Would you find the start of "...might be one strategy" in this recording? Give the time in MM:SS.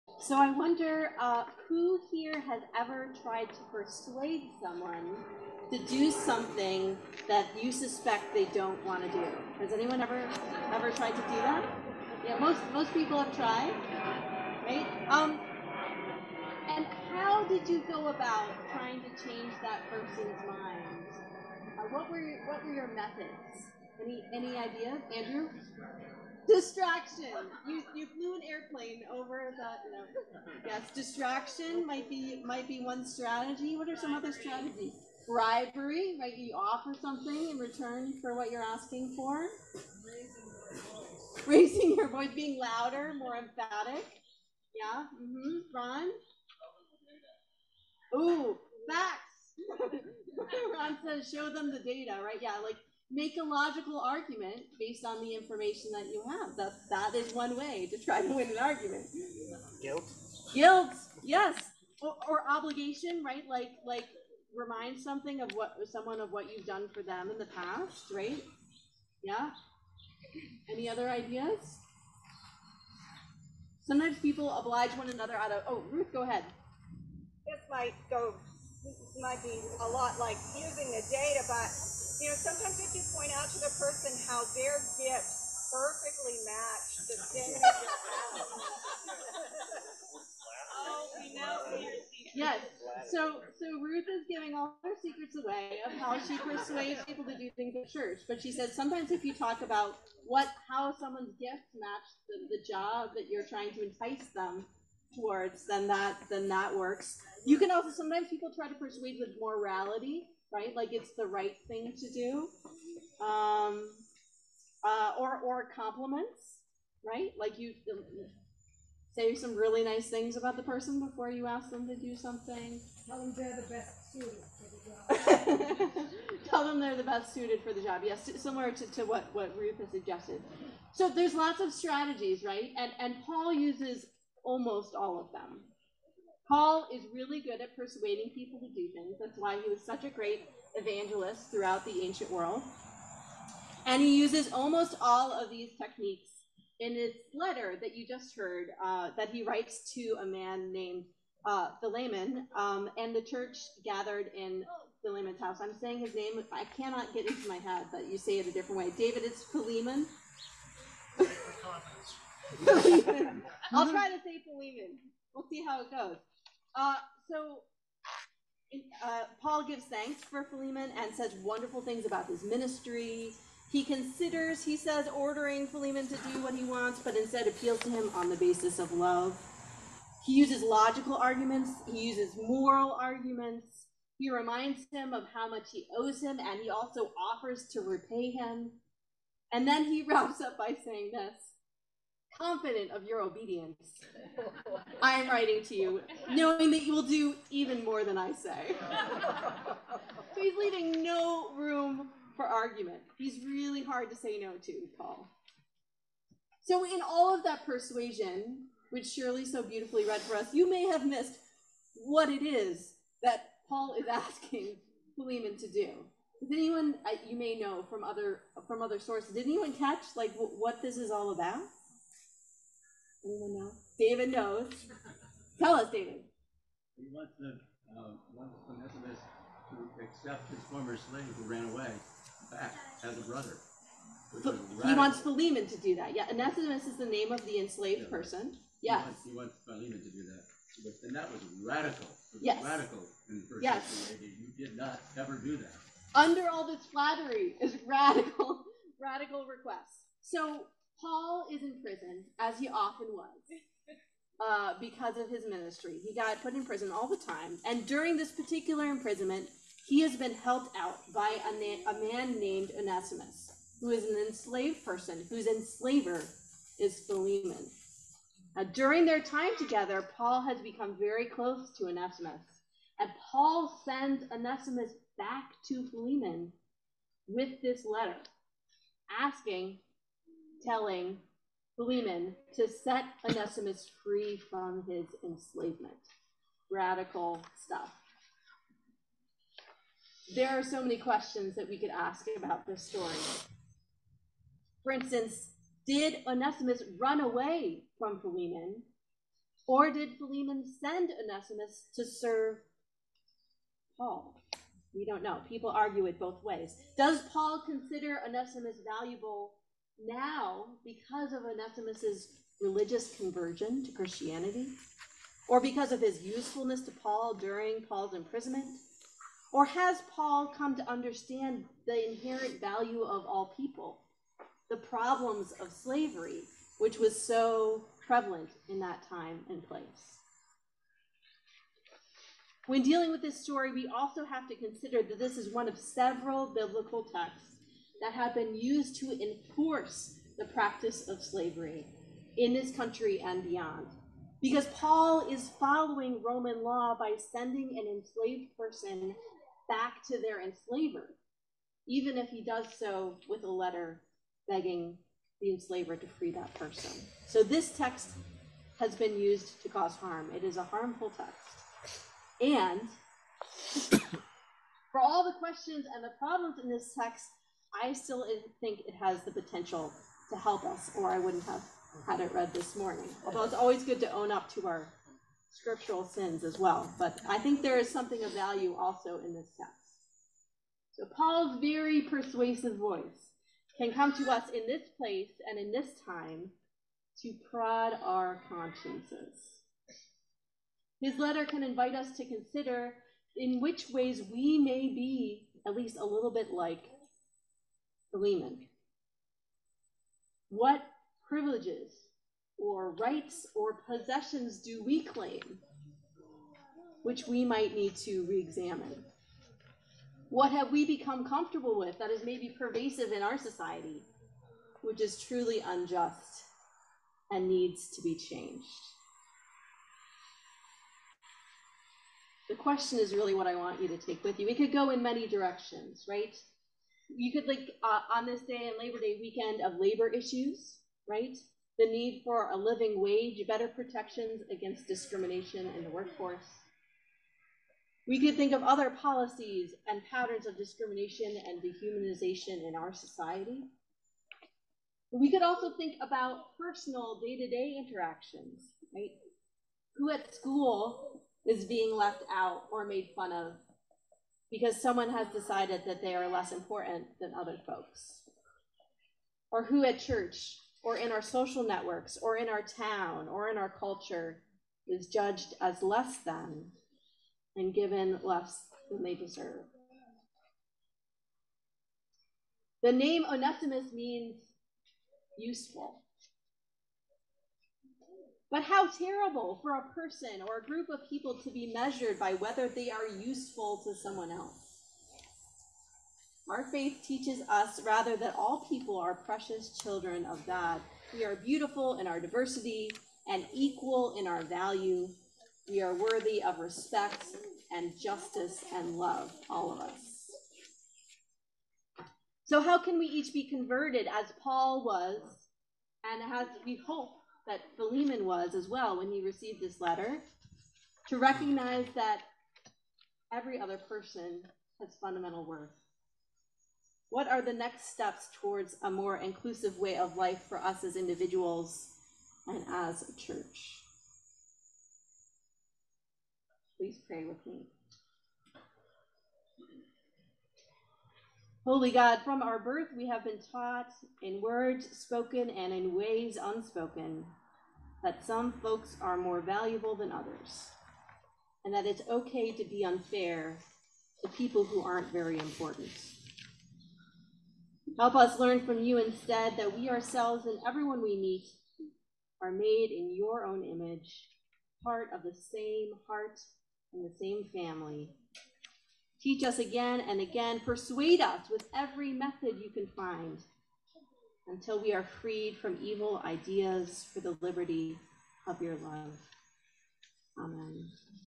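00:32.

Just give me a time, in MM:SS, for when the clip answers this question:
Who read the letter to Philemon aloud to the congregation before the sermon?
03:29.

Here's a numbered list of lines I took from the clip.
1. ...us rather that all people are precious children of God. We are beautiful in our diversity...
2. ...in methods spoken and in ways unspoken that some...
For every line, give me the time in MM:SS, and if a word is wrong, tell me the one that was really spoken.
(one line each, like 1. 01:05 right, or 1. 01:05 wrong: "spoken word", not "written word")
1. 08:07 right
2. 08:54 wrong: "words", not "methods".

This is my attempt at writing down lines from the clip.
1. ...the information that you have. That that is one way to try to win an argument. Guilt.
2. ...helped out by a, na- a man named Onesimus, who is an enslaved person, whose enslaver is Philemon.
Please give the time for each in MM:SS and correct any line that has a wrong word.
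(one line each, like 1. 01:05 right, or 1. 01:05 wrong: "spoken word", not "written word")
1. 00:55 right
2. 04:20 right.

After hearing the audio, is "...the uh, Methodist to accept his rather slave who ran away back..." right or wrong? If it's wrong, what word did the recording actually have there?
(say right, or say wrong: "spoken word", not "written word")
wrong: "former", not "rather".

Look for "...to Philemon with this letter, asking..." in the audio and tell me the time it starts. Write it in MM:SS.
04:35.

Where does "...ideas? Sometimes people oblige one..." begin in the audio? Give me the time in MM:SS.
01:11.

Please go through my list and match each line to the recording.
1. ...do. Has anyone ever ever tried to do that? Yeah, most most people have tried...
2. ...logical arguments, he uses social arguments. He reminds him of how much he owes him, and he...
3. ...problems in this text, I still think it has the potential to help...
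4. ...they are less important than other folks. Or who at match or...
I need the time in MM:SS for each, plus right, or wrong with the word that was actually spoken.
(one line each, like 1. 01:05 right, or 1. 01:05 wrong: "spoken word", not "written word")
1. 00:09 right
2. 03:00 wrong: "moral", not "social"
3. 06:06 right
4. 07:36 wrong: "church", not "match".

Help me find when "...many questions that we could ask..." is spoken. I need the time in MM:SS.
04:50.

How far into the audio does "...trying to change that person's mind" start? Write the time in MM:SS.
00:18.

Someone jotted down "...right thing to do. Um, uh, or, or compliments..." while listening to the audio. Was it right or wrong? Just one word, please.
right.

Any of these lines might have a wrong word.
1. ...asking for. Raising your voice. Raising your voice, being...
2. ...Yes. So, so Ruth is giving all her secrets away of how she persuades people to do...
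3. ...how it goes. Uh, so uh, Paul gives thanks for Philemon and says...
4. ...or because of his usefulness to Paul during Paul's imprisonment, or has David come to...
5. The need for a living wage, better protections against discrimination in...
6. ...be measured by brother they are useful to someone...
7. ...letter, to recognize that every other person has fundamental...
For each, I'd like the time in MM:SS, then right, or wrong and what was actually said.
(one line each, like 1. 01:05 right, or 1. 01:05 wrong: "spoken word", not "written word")
1. 00:38 right
2. 01:32 right
3. 02:45 right
4. 05:15 wrong: "Paul", not "David"
5. 07:11 right
6. 08:01 wrong: "whether", not "brother"
7. 08:29 right.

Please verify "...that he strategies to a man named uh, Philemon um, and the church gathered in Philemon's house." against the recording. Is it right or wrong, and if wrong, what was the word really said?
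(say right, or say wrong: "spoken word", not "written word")
wrong: "writes", not "strategies".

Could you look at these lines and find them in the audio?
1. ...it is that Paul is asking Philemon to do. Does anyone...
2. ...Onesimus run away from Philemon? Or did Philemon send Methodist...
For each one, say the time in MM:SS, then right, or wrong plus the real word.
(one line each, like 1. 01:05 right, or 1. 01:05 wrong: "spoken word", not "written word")
1. 03:32 right
2. 04:56 wrong: "Onesimus", not "Methodist".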